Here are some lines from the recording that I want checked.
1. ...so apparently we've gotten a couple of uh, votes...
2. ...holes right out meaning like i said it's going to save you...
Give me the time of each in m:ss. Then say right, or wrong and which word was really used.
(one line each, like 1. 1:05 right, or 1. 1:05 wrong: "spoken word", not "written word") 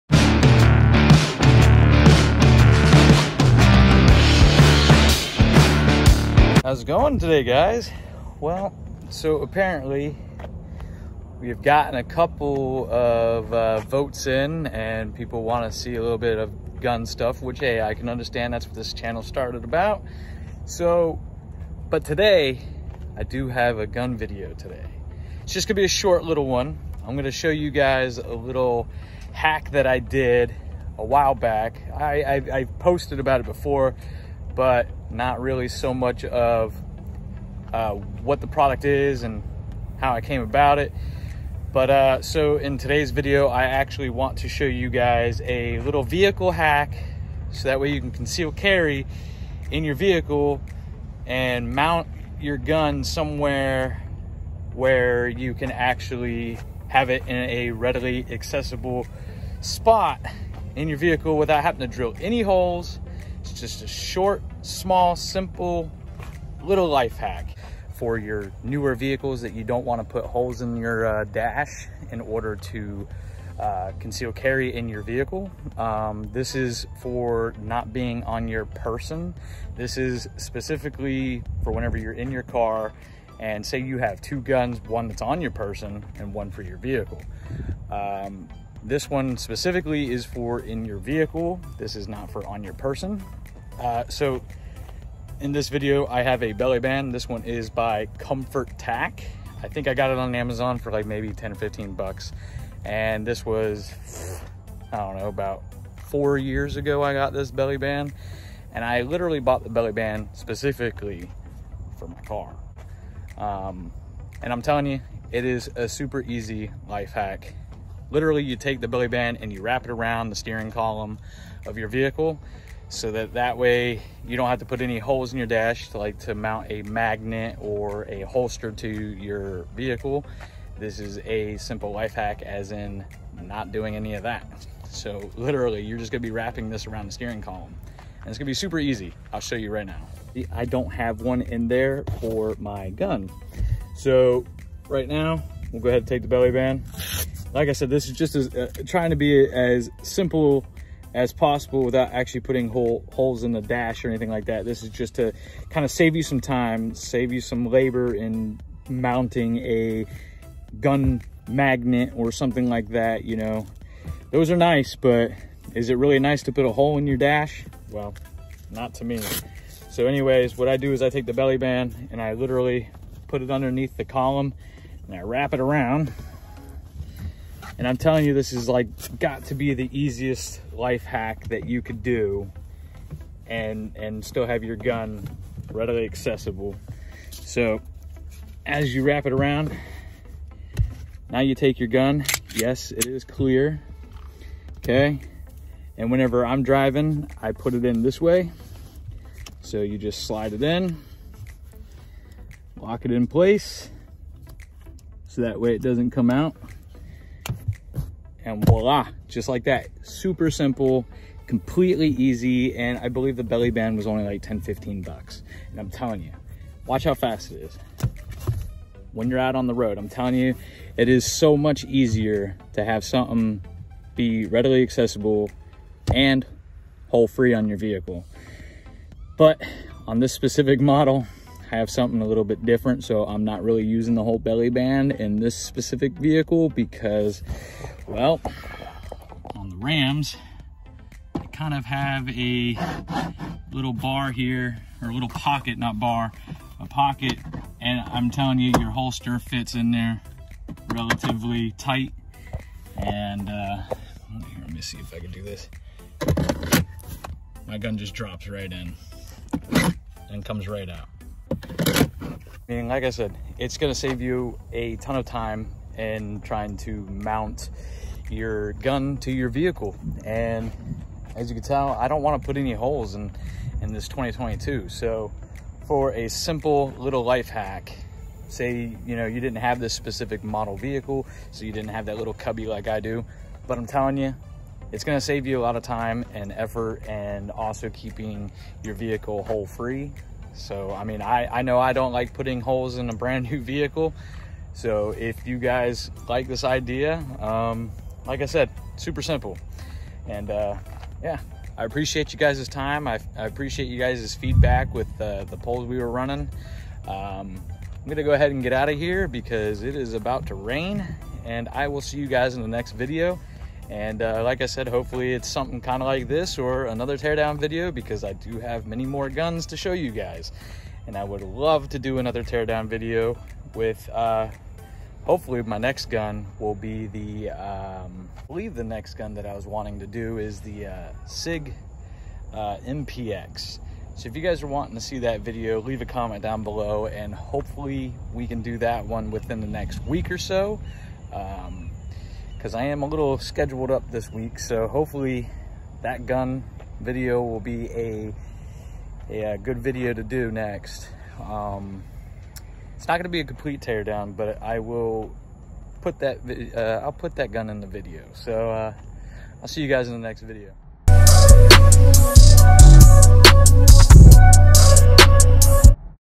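1. 0:09 right
2. 4:20 wrong: "comes", not "holes".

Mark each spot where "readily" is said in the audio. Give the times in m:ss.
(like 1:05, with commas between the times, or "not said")
0:57, 3:05, 3:44.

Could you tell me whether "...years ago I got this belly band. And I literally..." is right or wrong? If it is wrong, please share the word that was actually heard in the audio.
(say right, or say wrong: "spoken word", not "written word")
right.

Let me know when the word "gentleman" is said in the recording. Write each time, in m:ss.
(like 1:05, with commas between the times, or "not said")
not said.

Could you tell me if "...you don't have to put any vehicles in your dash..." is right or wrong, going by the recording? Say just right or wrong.
wrong.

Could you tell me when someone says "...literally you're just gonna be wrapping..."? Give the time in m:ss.
2:15.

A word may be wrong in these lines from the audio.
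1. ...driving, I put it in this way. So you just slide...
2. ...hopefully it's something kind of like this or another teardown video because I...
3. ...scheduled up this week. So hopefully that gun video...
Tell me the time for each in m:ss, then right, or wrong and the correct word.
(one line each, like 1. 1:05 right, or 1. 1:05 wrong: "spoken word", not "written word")
1. 3:16 right
2. 5:14 right
3. 5:43 right.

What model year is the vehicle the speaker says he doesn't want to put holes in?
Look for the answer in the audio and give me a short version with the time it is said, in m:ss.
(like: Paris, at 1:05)
2022, at 4:34.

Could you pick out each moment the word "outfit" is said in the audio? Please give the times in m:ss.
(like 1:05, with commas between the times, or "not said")
not said.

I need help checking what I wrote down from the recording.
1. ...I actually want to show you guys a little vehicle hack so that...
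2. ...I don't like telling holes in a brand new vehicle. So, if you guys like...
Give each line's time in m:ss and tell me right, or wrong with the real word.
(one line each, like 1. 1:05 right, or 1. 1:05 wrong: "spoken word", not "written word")
1. 0:43 right
2. 4:51 wrong: "putting", not "telling".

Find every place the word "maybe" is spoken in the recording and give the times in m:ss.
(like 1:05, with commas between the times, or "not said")
1:41.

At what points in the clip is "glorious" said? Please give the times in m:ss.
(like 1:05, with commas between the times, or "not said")
not said.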